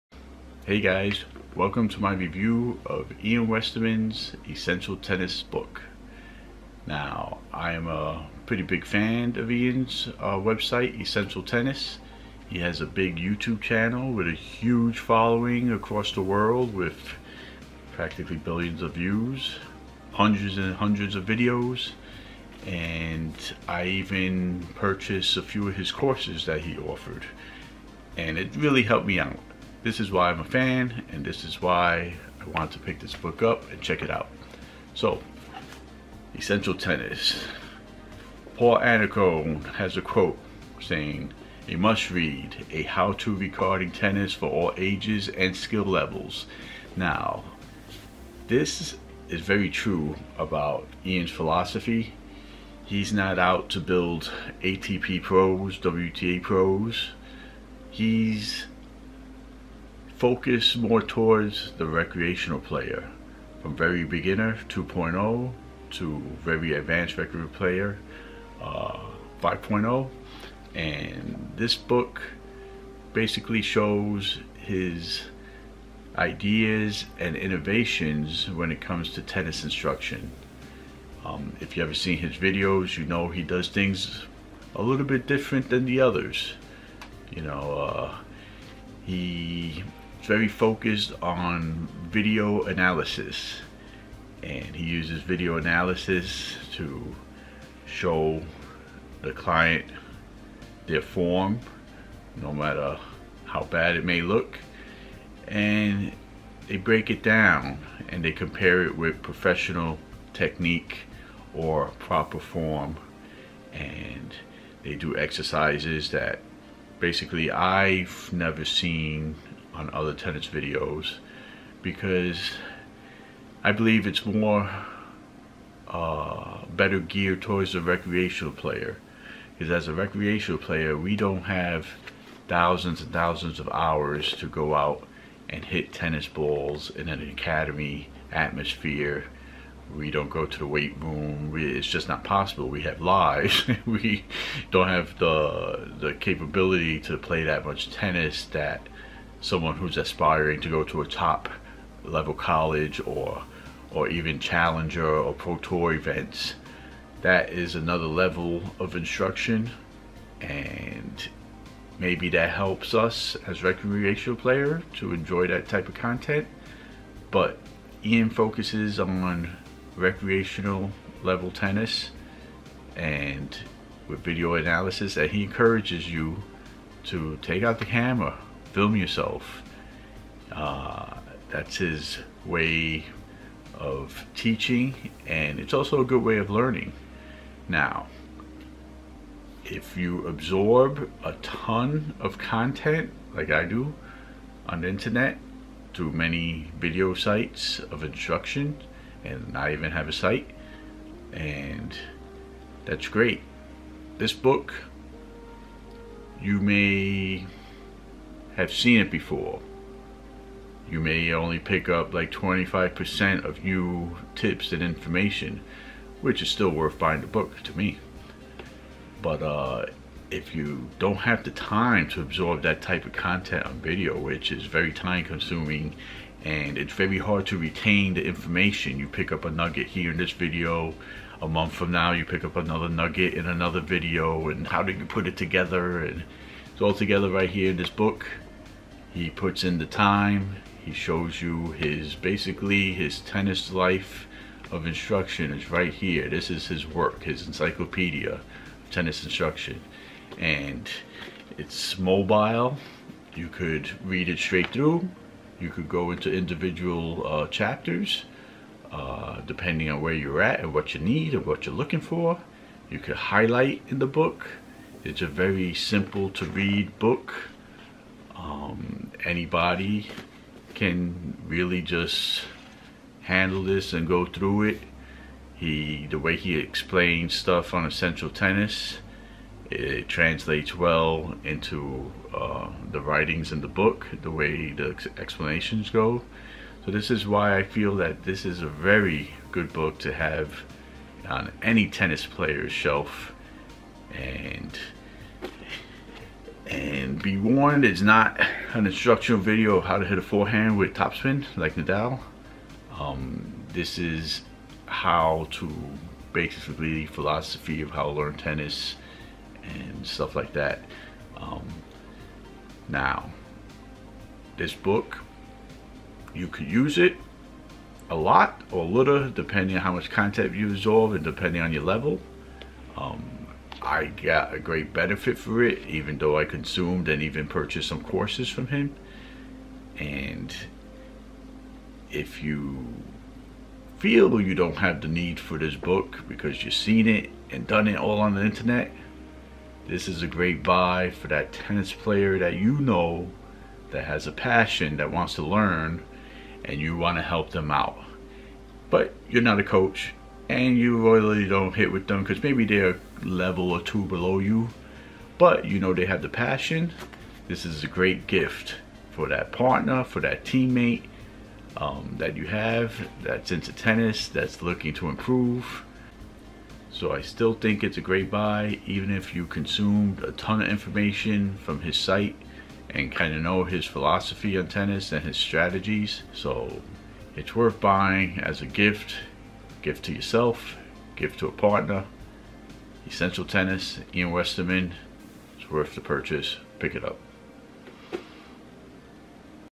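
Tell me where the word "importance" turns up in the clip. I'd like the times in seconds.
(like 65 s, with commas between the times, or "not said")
not said.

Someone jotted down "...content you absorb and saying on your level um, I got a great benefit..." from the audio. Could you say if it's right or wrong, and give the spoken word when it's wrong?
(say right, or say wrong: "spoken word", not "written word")
wrong: "depending", not "saying".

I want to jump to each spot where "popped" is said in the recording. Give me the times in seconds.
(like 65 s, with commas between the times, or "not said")
not said.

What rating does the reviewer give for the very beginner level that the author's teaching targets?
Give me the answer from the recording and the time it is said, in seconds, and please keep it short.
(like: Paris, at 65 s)
2.0, at 64 s.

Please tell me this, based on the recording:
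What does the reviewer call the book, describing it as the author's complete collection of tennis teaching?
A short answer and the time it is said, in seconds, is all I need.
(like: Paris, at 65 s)
encyclopedia of tennis instruction, at 247 s.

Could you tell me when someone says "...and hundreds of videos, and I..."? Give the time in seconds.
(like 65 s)
20 s.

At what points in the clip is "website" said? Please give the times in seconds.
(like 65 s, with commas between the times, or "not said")
10 s.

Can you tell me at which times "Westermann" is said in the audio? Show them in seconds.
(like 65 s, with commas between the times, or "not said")
3 s, 384 s.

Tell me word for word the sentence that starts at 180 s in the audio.
Uh, that's his way of teaching, and it's also a good way of learning.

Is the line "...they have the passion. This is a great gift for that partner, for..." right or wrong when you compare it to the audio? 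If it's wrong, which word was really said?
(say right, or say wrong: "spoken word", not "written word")
right.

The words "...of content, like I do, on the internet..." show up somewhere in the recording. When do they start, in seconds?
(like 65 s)
192 s.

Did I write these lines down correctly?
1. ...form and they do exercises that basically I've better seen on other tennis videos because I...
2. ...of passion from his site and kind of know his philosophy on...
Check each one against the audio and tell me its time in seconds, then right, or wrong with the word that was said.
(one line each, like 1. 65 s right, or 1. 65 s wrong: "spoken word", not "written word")
1. 112 s wrong: "never", not "better"
2. 370 s wrong: "information", not "passion".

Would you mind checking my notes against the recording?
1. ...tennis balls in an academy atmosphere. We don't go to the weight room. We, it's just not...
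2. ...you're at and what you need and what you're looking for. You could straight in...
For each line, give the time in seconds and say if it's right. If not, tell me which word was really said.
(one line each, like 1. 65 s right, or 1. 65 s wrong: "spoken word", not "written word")
1. 135 s right
2. 260 s wrong: "highlight", not "straight".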